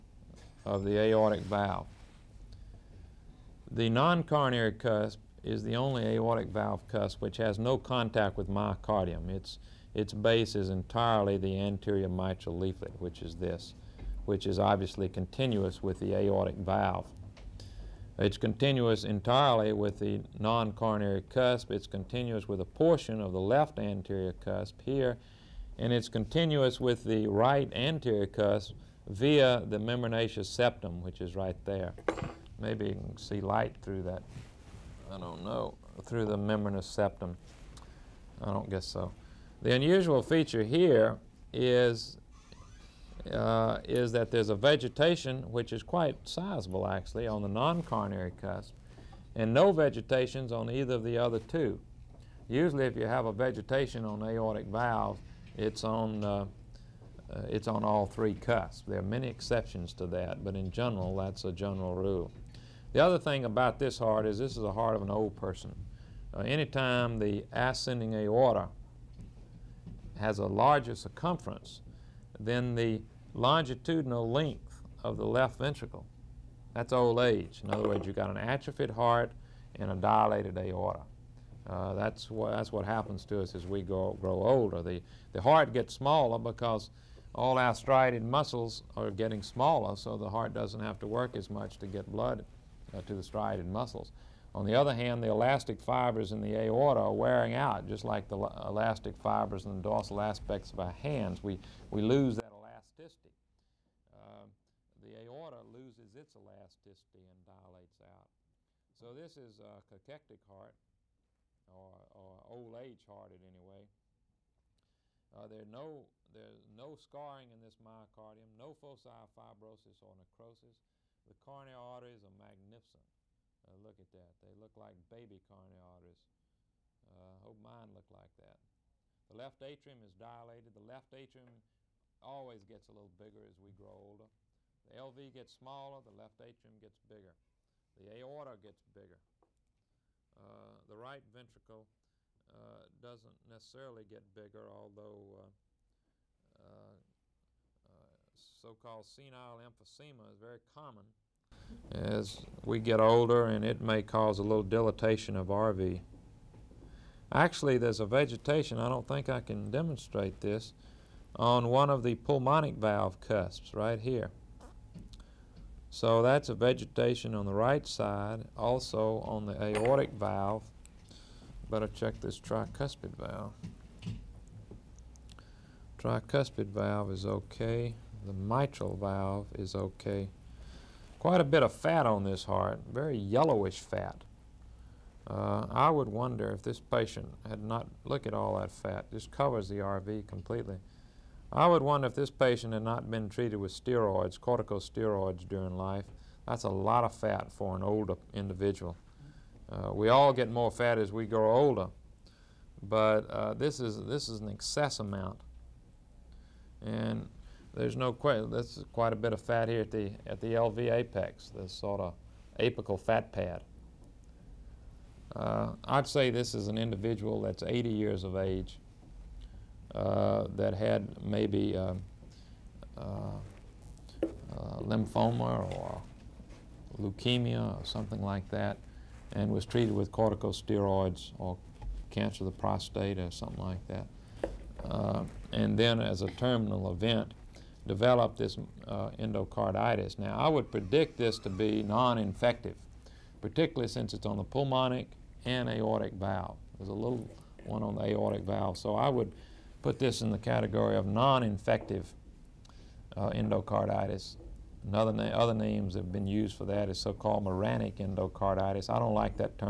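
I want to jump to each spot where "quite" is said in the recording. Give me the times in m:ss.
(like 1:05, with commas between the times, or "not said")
0:45, 3:01, 3:28.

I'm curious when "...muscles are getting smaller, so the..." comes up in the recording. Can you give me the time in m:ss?
1:28.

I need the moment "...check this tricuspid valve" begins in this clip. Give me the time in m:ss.
2:51.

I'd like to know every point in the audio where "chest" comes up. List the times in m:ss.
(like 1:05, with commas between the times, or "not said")
not said.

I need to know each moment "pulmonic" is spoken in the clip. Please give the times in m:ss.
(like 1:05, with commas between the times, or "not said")
2:42, 4:04.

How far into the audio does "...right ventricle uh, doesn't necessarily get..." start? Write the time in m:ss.
2:20.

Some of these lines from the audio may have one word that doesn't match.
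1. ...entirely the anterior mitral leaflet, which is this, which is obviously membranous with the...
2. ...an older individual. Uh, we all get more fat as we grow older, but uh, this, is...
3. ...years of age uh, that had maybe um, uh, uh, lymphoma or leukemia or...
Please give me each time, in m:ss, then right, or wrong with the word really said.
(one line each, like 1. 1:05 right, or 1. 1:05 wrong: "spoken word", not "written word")
1. 0:10 wrong: "continuous", not "membranous"
2. 3:17 right
3. 3:37 right.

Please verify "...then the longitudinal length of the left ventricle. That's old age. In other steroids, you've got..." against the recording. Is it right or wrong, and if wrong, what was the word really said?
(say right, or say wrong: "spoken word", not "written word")
wrong: "words", not "steroids".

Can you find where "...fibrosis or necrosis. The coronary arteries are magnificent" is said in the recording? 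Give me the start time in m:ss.
1:59.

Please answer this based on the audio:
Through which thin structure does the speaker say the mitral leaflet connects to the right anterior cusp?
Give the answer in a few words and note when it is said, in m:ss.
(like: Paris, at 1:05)
Membranous septum, at 0:29.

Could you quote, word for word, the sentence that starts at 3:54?
Uh, and then as a terminal event, develop this uh, endocarditis.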